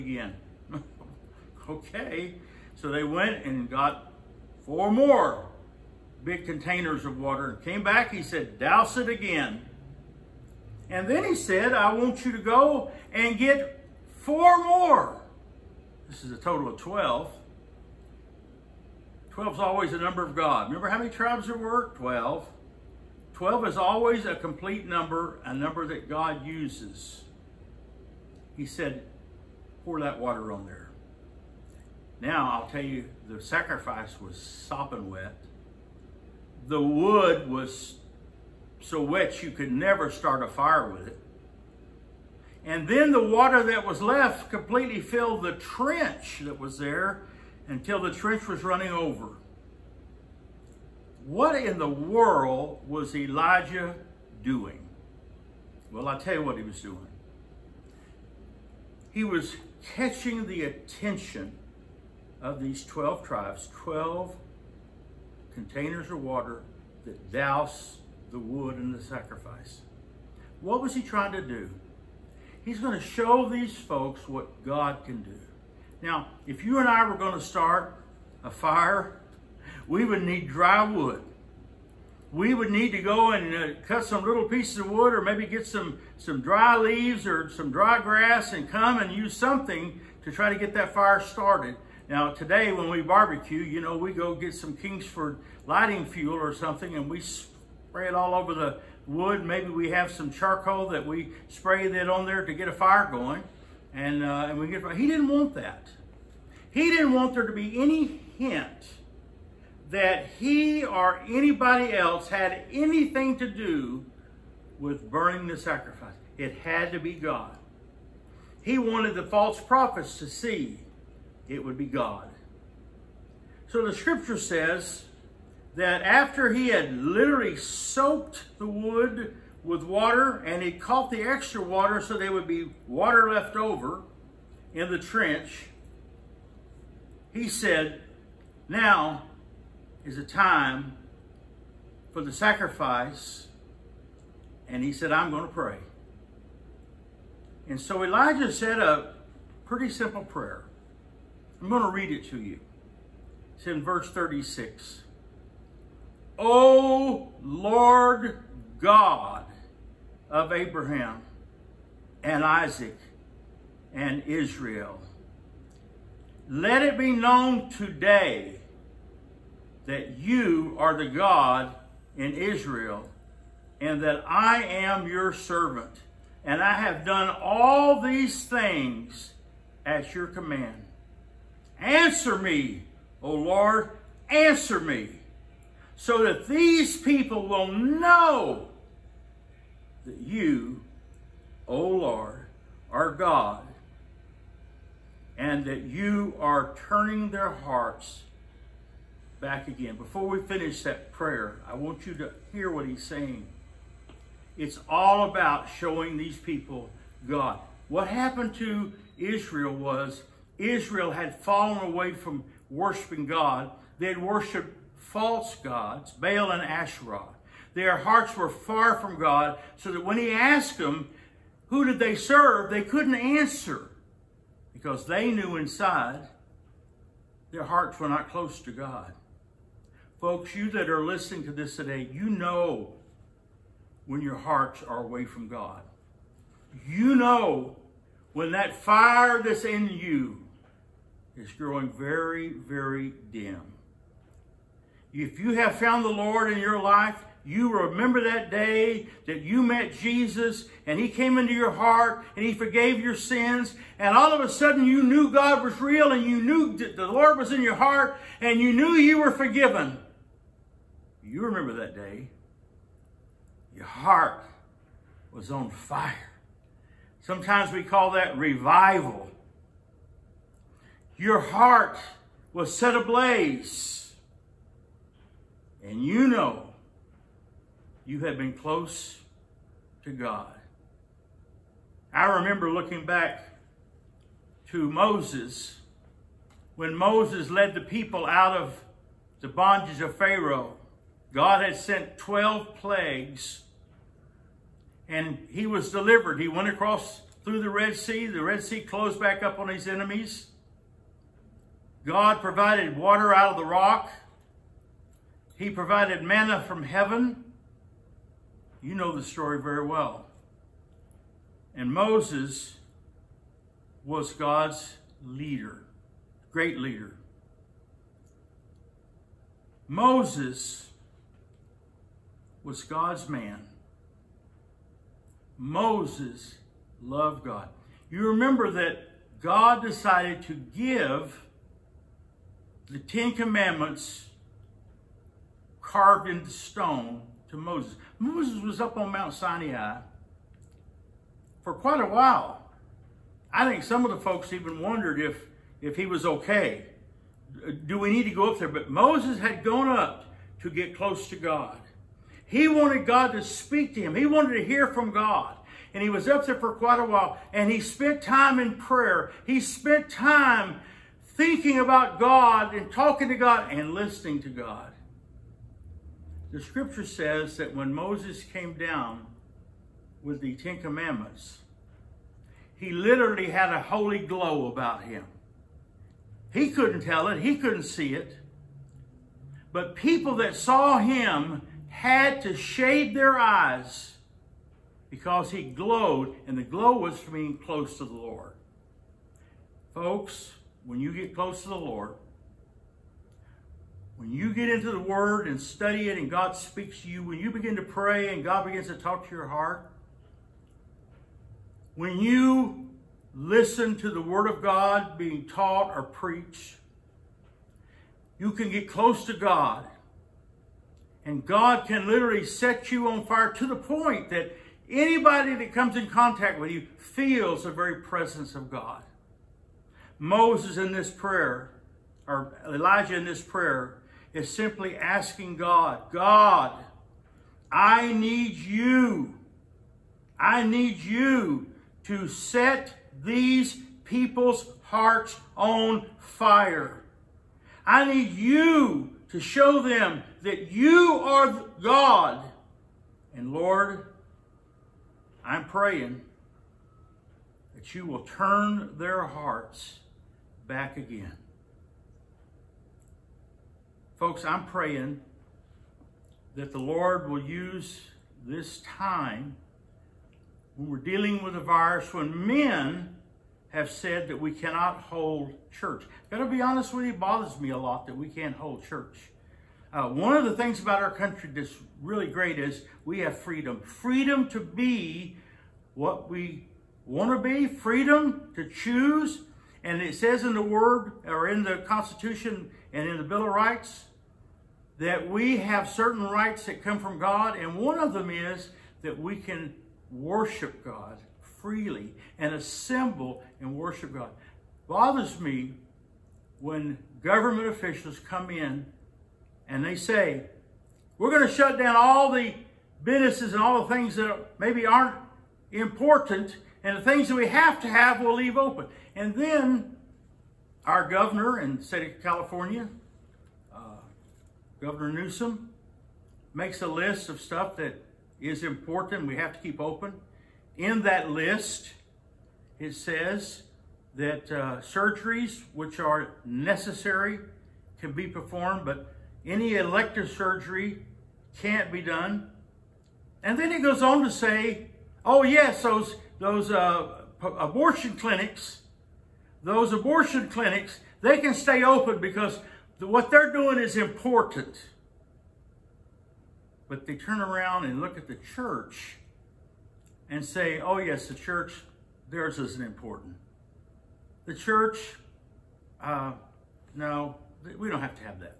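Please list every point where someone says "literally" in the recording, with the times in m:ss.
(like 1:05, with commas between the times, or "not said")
2:06, 6:12, 6:52.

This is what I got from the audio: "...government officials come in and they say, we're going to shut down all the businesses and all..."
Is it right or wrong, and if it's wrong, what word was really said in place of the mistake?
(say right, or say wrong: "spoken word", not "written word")
right.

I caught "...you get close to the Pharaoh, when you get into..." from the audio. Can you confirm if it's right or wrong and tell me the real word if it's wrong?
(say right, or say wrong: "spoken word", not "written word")
wrong: "Lord", not "Pharaoh".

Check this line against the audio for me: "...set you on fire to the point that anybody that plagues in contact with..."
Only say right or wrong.
wrong.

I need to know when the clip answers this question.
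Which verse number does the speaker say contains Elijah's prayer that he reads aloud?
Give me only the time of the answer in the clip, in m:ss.
2:33.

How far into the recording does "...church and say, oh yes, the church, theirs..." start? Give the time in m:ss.
9:08.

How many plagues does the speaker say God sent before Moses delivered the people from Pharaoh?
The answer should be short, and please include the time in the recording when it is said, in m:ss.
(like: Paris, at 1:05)
12, at 4:52.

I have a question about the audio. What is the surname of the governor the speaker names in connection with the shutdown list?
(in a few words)
Newsom.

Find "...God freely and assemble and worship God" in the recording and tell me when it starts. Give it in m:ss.
8:10.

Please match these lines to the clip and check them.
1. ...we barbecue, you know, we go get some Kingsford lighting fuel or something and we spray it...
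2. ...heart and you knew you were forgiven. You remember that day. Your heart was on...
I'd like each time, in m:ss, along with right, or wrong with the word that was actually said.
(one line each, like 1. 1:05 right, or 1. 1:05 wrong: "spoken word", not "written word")
1. 1:32 right
2. 4:17 right.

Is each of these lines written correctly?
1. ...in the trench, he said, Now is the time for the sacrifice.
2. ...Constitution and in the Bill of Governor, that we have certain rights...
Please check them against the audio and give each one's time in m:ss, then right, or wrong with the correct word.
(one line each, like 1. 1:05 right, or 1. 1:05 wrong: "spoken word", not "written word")
1. 2:14 right
2. 8:01 wrong: "Rights", not "Governor".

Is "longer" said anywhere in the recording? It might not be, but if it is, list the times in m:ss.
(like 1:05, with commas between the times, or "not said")
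not said.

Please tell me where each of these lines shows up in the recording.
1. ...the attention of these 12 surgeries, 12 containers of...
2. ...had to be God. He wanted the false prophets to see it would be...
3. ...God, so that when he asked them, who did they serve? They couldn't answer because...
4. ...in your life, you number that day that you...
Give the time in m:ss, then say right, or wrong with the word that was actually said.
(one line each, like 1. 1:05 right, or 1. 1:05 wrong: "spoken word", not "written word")
1. 1:00 wrong: "tribes", not "surgeries"
2. 1:56 right
3. 3:39 right
4. 4:06 wrong: "remember", not "number".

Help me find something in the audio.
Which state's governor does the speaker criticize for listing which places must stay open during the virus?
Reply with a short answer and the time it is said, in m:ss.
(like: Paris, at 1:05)
California, at 8:32.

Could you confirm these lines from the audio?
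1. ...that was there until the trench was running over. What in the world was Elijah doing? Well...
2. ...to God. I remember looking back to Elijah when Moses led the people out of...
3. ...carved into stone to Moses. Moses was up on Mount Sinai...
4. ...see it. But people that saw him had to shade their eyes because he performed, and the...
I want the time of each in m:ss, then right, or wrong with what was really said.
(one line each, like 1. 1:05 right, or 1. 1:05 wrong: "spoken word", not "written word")
1. 0:46 right
2. 4:40 wrong: "Moses", not "Elijah"
3. 5:35 right
4. 6:17 wrong: "glowed", not "performed".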